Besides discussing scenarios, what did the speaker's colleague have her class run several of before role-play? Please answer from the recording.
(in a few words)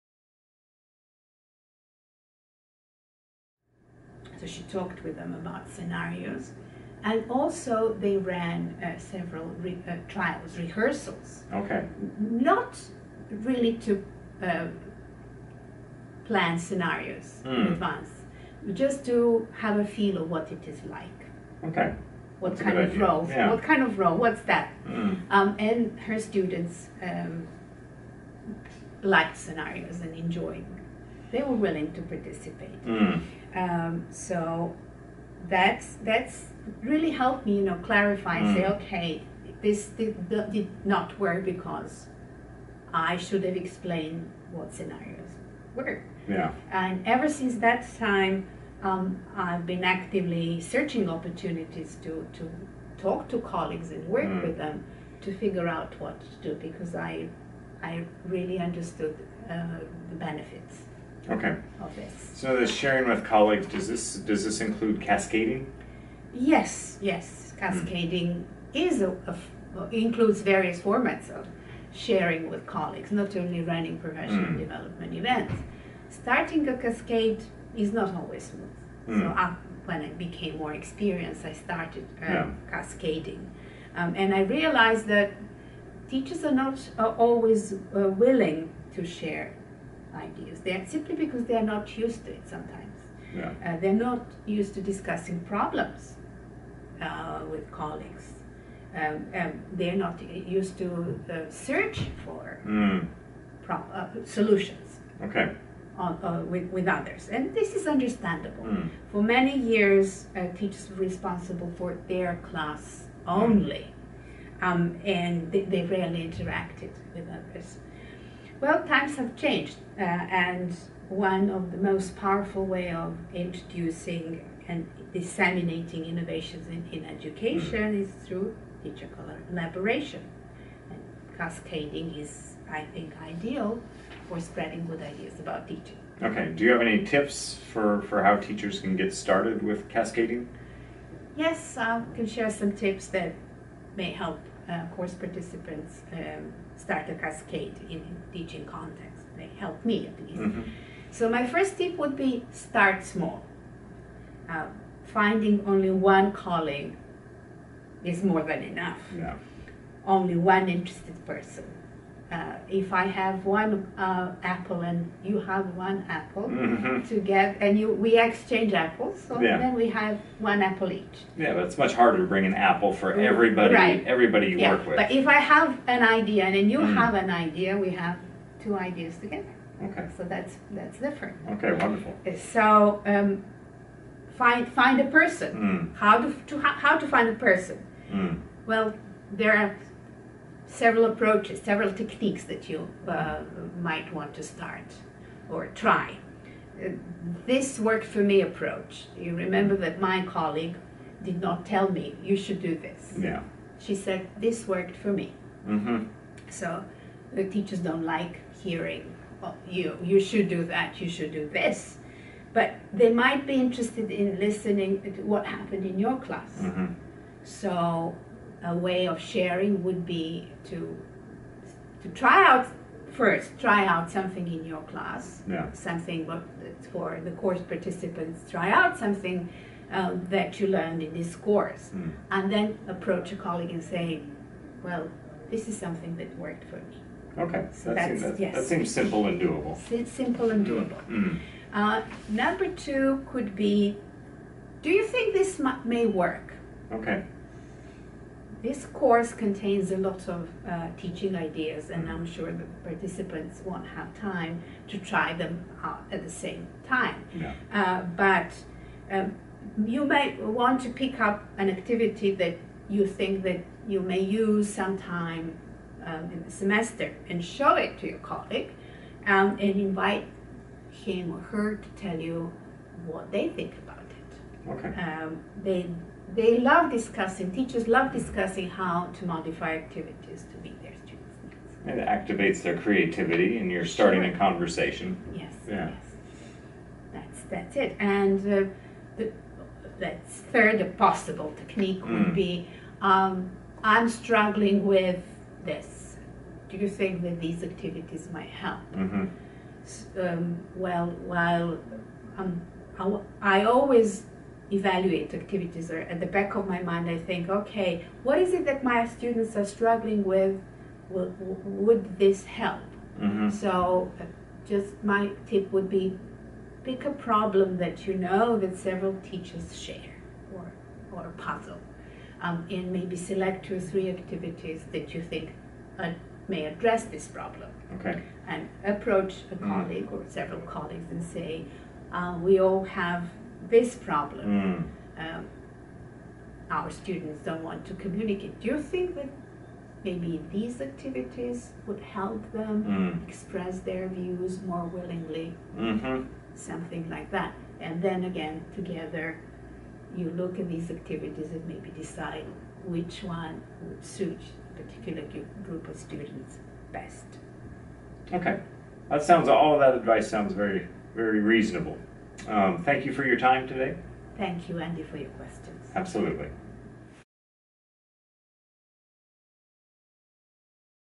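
rehearsals.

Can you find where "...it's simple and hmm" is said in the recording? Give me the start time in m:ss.
3:59.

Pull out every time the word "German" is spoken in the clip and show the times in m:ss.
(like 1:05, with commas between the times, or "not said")
not said.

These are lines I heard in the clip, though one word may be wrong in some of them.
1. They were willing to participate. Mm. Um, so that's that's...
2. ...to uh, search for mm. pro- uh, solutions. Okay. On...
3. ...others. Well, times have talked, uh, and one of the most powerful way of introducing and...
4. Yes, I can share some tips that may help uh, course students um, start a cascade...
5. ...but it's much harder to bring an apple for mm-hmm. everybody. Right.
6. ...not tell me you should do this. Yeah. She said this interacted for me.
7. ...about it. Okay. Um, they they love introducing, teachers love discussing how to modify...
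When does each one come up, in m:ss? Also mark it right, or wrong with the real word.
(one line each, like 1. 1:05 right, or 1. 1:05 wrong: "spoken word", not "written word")
1. 0:31 right
2. 1:40 right
3. 1:57 wrong: "changed", not "talked"
4. 2:21 wrong: "participants", not "students"
5. 2:51 right
6. 3:21 wrong: "worked", not "interacted"
7. 4:33 wrong: "discussing", not "introducing".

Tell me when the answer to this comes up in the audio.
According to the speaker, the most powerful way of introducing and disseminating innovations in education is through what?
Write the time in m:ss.
2:08.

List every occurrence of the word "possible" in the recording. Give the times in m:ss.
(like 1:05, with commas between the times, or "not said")
4:50.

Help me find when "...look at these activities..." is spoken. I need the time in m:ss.
5:50.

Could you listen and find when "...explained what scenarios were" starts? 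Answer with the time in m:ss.
0:43.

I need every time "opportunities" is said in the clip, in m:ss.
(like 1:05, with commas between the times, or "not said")
0:51.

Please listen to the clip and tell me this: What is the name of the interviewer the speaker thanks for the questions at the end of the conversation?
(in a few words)
Andy.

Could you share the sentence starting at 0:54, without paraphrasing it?
with them to figure out what to do because I, I really understood uh, the benefits.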